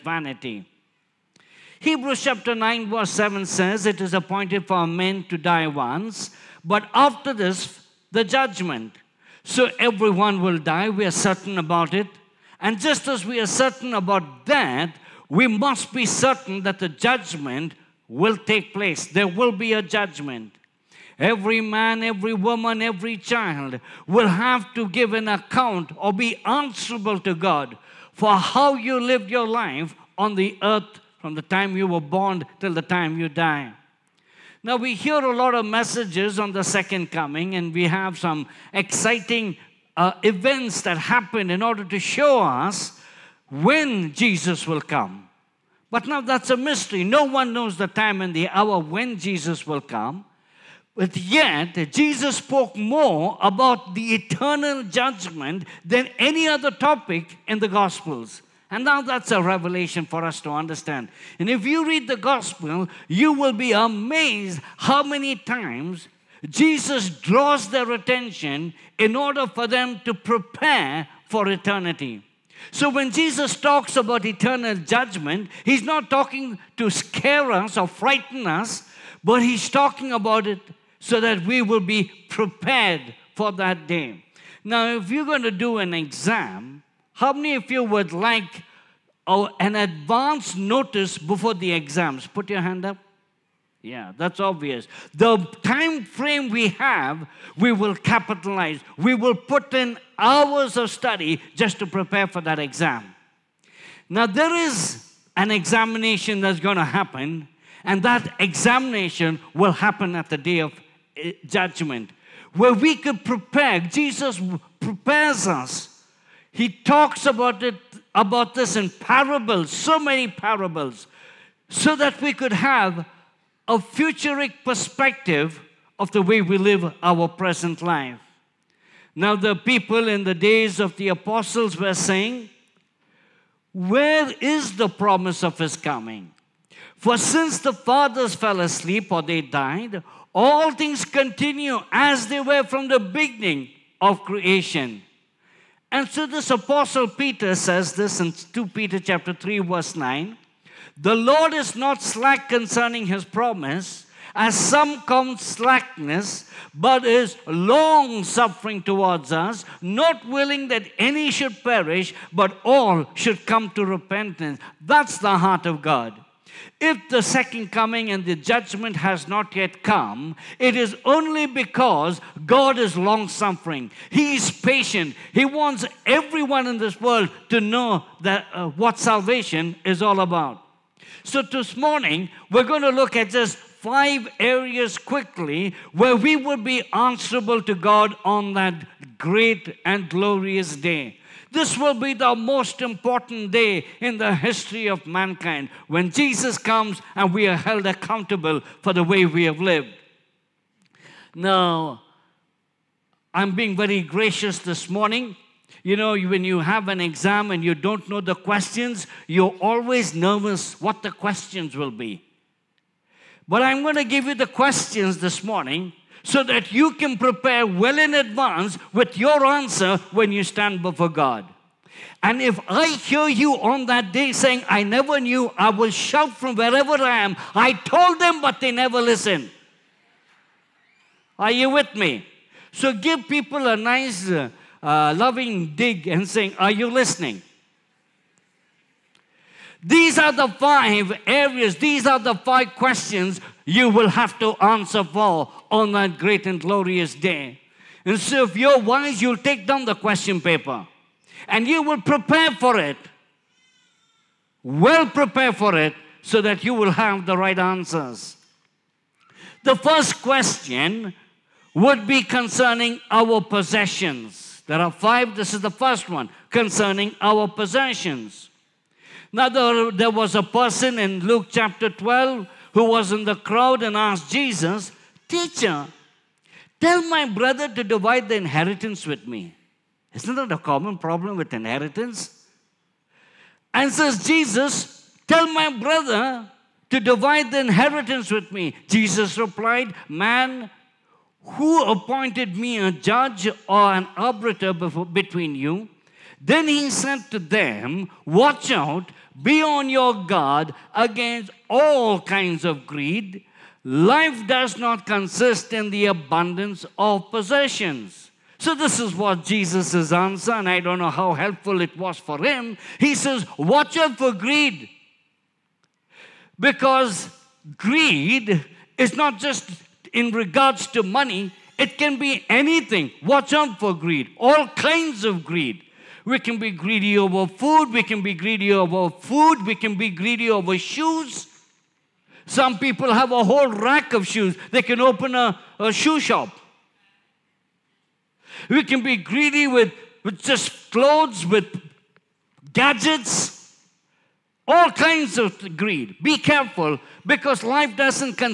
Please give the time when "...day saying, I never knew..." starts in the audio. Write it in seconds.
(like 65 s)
224 s.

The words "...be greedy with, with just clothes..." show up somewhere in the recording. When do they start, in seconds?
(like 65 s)
339 s.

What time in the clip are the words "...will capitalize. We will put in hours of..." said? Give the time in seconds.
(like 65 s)
97 s.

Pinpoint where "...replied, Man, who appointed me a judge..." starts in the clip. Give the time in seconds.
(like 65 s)
289 s.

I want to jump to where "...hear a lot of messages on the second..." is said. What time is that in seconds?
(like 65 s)
34 s.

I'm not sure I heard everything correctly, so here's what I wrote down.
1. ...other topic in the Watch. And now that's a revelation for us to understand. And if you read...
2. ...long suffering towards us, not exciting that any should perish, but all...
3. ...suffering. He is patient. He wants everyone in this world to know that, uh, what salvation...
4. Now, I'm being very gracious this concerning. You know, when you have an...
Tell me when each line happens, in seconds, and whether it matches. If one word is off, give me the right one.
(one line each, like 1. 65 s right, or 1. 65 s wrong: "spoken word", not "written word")
1. 56 s wrong: "Gospels", not "Watch"
2. 157 s wrong: "willing", not "exciting"
3. 173 s right
4. 201 s wrong: "morning", not "concerning".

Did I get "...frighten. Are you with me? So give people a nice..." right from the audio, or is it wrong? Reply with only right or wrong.
wrong.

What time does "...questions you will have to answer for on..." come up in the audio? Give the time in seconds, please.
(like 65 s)
242 s.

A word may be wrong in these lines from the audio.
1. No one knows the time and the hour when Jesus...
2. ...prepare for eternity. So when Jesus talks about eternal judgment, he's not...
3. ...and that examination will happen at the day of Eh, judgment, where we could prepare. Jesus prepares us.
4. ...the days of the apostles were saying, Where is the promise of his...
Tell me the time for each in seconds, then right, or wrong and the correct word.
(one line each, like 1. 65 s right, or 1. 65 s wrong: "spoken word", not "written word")
1. 47 s right
2. 70 s right
3. 107 s right
4. 130 s right.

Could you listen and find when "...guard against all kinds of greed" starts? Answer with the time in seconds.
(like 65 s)
300 s.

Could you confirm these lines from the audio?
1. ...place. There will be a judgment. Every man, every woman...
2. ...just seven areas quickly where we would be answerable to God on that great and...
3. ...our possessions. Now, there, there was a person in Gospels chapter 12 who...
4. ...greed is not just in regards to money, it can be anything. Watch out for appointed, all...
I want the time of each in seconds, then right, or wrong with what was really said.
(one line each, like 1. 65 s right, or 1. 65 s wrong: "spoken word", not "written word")
1. 18 s right
2. 183 s wrong: "five", not "seven"
3. 267 s wrong: "Luke", not "Gospels"
4. 317 s wrong: "greed", not "appointed".